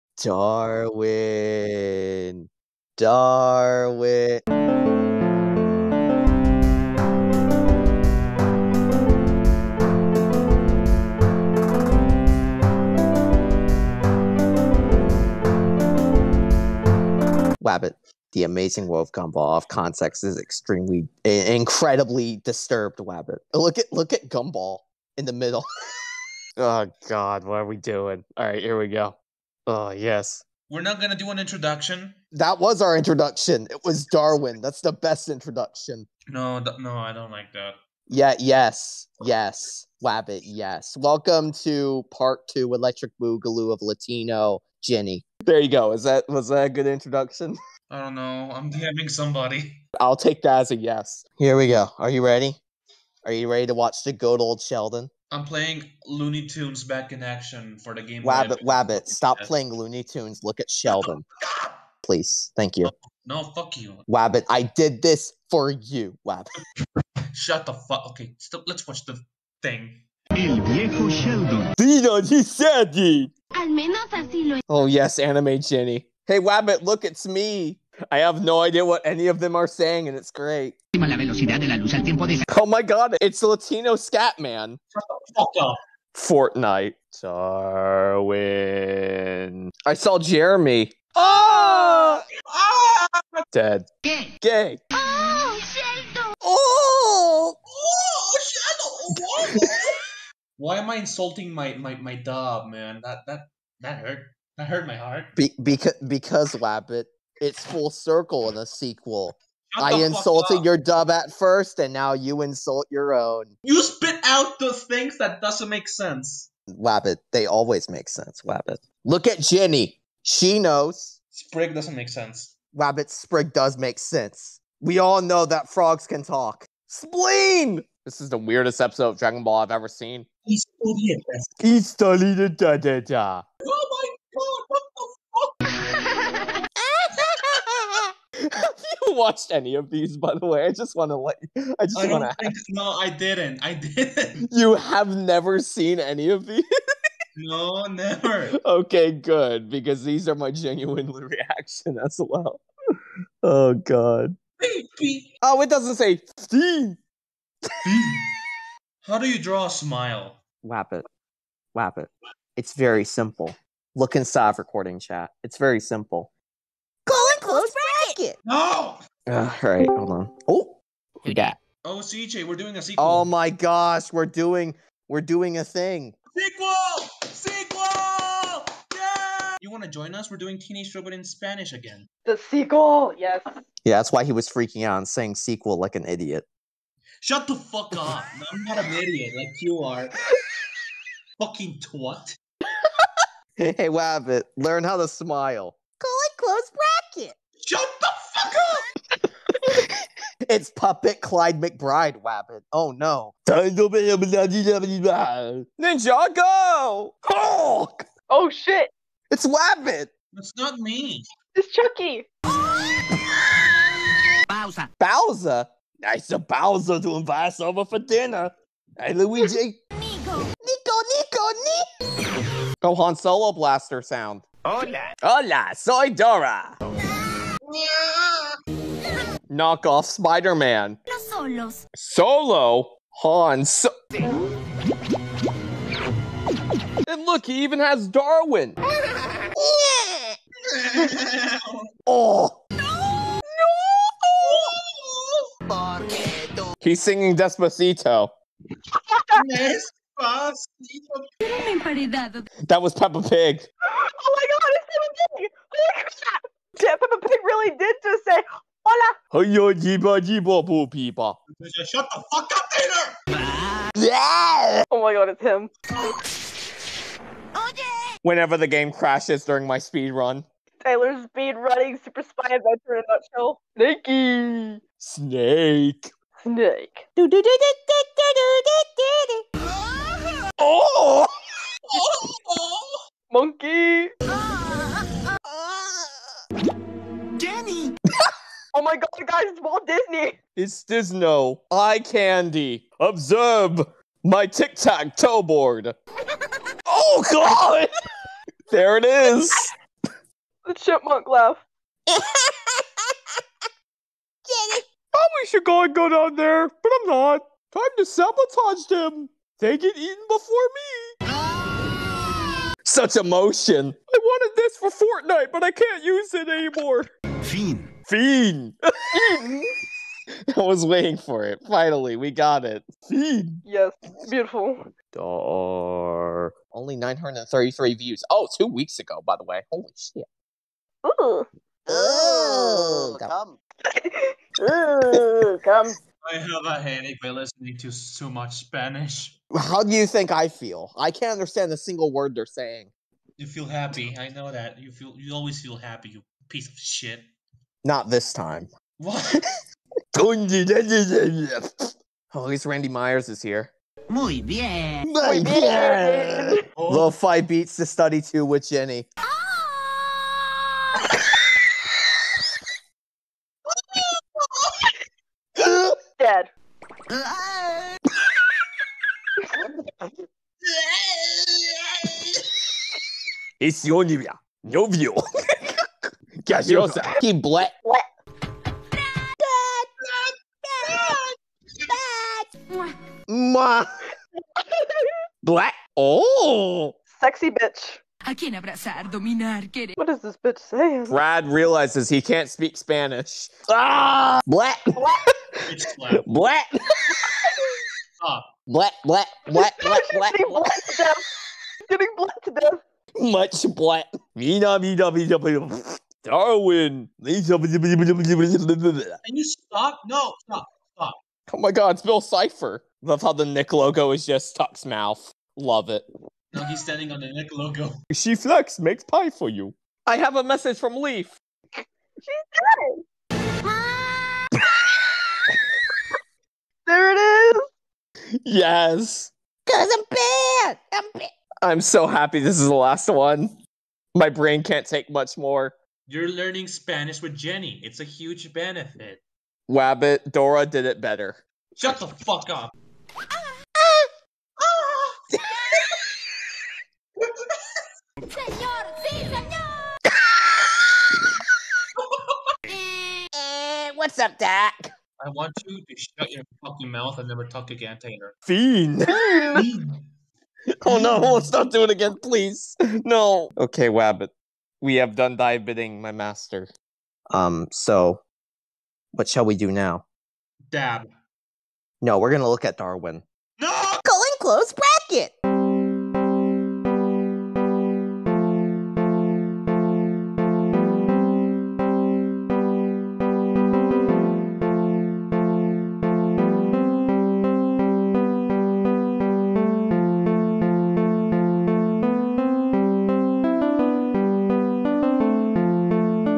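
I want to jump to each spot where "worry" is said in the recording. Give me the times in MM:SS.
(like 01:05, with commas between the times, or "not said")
not said.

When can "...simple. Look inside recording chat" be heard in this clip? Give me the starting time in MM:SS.
02:43.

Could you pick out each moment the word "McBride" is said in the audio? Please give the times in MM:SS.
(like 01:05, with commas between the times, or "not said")
03:21.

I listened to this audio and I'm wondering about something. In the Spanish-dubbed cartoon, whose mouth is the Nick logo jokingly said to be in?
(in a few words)
Tuck's.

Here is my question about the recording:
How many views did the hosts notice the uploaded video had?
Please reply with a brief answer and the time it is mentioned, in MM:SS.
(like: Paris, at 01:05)
933, at 05:26.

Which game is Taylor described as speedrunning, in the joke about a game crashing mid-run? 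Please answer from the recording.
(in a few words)
Super Spy Adventure.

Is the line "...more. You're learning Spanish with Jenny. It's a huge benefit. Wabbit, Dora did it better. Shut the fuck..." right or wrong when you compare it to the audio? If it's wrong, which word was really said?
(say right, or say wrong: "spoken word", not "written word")
right.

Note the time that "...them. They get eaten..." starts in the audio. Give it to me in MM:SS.
05:08.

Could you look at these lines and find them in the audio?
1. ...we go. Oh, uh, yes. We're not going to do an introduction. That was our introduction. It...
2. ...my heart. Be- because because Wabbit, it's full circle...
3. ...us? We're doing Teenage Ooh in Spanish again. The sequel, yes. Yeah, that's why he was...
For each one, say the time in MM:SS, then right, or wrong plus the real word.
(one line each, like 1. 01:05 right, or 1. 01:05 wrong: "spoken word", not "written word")
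1. 00:28 right
2. 01:44 right
3. 03:00 wrong: "Robot", not "Ooh".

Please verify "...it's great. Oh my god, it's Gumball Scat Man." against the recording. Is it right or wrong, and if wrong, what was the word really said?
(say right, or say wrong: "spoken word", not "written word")
wrong: "Latino", not "Gumball".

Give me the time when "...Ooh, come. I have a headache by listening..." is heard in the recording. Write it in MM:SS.
05:34.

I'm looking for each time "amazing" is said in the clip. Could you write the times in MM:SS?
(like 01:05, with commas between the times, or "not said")
00:18.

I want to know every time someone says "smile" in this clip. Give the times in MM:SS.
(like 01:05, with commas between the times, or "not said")
02:39, 03:15.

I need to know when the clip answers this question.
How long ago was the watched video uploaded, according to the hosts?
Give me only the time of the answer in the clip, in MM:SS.
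05:28.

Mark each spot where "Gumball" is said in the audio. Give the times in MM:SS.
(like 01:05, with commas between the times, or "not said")
00:19, 00:24.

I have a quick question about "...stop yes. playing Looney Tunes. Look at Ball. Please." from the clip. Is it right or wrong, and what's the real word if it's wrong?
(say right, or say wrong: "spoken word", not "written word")
wrong: "Sheldon", not "Ball".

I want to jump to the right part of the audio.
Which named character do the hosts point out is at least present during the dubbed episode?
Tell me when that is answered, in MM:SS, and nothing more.
05:52.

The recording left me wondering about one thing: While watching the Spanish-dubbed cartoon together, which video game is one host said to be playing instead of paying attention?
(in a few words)
Looney Tunes: Back in Action.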